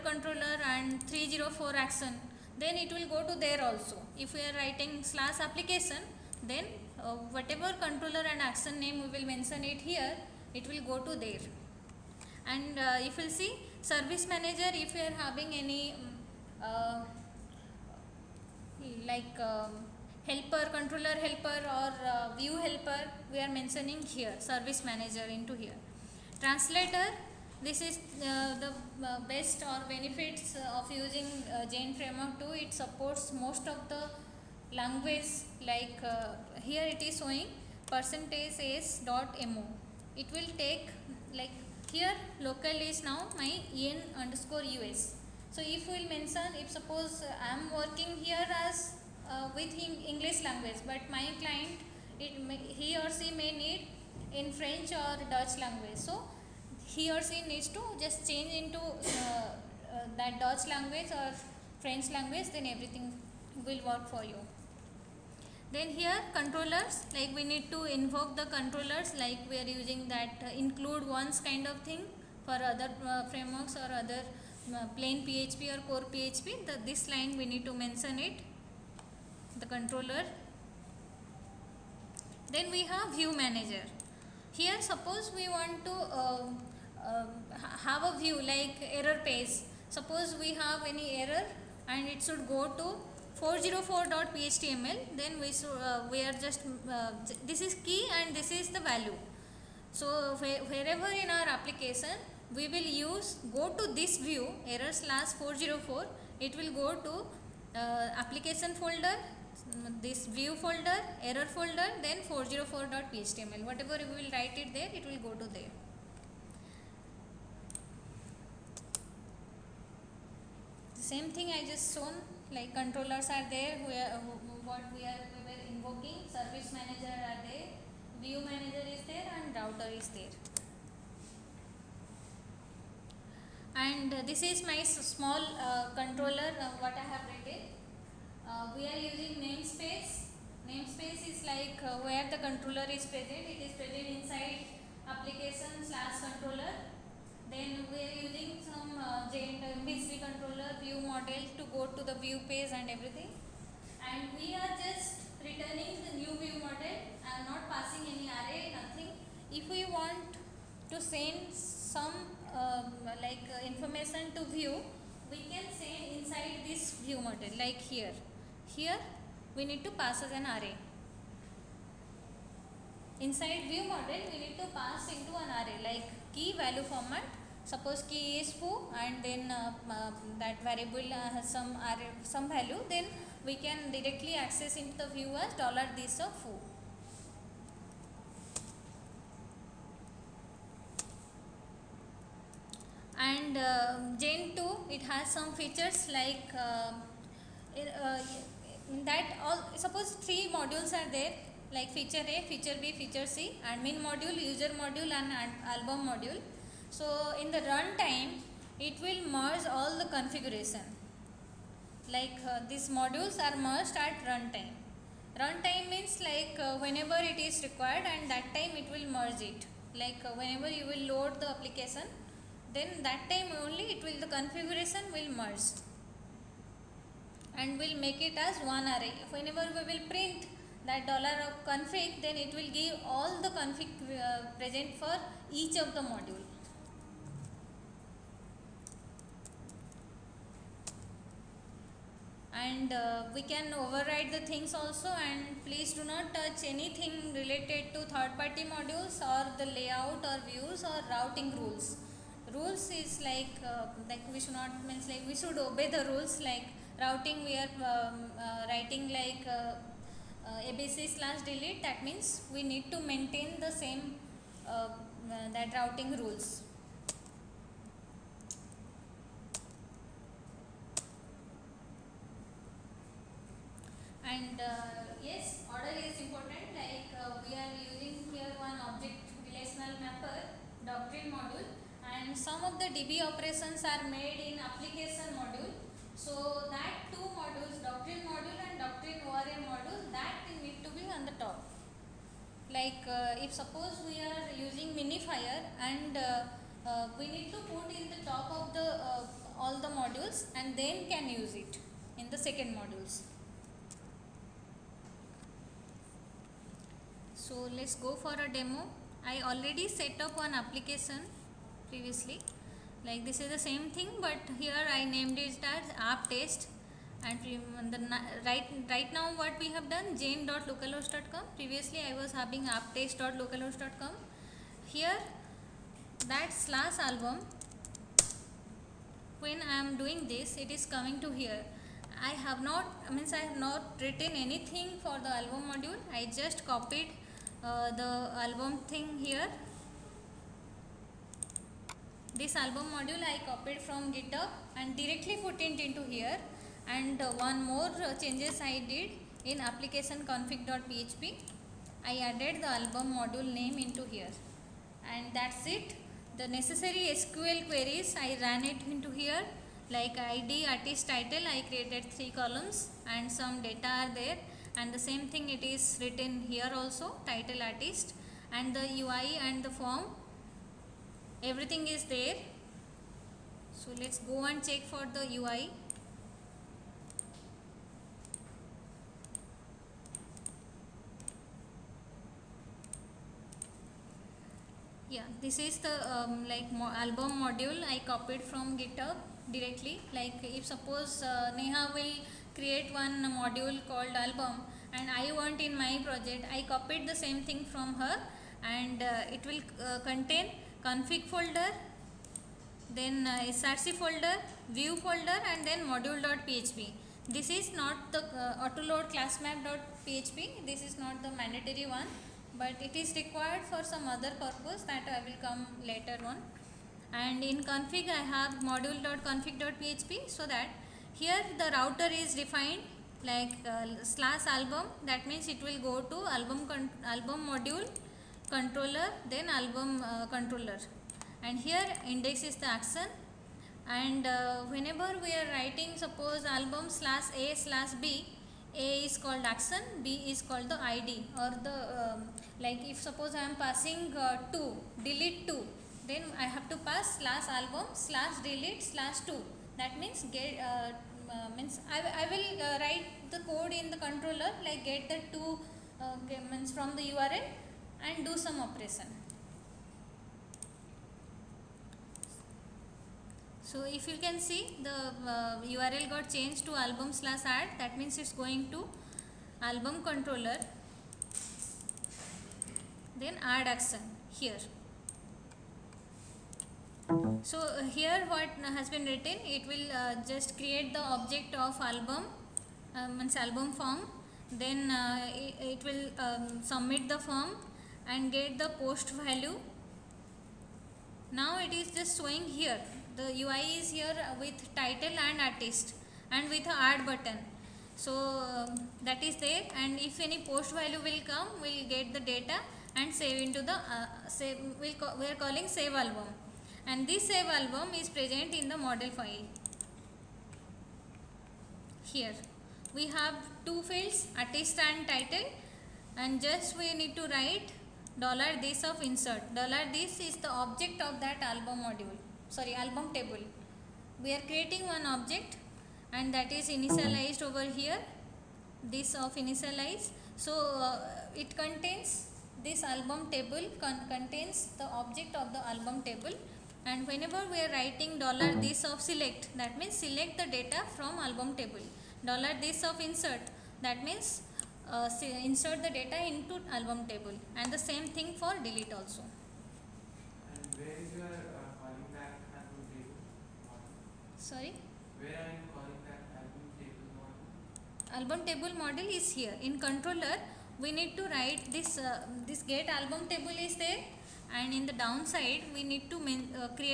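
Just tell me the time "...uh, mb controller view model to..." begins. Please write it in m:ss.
2:28.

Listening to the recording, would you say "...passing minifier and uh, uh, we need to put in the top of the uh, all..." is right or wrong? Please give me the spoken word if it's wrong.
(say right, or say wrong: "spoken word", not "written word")
wrong: "using", not "passing".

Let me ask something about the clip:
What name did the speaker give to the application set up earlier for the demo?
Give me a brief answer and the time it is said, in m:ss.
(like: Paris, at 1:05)
app test, at 5:15.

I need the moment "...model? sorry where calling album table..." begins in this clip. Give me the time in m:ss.
9:13.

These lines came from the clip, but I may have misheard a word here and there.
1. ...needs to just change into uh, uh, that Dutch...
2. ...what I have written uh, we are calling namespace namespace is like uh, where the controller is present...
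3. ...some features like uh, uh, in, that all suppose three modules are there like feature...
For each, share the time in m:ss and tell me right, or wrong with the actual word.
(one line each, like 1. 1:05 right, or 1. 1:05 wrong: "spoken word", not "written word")
1. 0:57 right
2. 2:16 wrong: "using", not "calling"
3. 3:15 right.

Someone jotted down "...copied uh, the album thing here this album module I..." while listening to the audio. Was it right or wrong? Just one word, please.
right.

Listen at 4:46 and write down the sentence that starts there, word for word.
So that two modules doctrine module and doctrine ORM module that need to be on the top.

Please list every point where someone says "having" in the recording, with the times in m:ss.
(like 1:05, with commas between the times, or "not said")
0:15, 5:22.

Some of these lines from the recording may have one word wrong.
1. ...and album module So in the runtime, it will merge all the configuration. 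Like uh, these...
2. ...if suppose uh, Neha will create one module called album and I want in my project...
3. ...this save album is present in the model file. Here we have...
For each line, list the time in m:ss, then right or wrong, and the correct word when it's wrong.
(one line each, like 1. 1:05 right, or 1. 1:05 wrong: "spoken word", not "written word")
1. 3:25 right
2. 6:30 right
3. 8:27 right.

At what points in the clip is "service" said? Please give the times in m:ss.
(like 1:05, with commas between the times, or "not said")
0:13, 0:24, 2:06.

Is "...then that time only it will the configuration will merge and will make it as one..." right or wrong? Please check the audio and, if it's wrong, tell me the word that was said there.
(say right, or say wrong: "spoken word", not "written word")
right.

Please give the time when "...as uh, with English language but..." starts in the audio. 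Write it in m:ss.
0:48.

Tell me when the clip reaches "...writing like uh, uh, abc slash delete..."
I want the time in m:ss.
4:18.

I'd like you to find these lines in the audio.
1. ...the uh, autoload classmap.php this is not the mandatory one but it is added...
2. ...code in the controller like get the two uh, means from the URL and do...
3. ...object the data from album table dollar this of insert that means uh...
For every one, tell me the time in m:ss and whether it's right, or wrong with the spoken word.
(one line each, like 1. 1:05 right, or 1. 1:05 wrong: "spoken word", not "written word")
1. 6:48 wrong: "required", not "added"
2. 7:33 right
3. 9:00 wrong: "select", not "object".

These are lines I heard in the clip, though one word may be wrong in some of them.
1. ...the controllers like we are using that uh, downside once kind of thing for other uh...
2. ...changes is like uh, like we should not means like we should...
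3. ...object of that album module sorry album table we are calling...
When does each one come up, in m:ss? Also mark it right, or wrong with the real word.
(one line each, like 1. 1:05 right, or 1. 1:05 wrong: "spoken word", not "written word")
1. 1:08 wrong: "include", not "downside"
2. 4:12 wrong: "rules", not "changes"
3. 8:40 wrong: "creating", not "calling".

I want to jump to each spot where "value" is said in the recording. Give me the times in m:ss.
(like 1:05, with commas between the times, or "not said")
1:38, 2:56, 3:02, 8:09, 8:20.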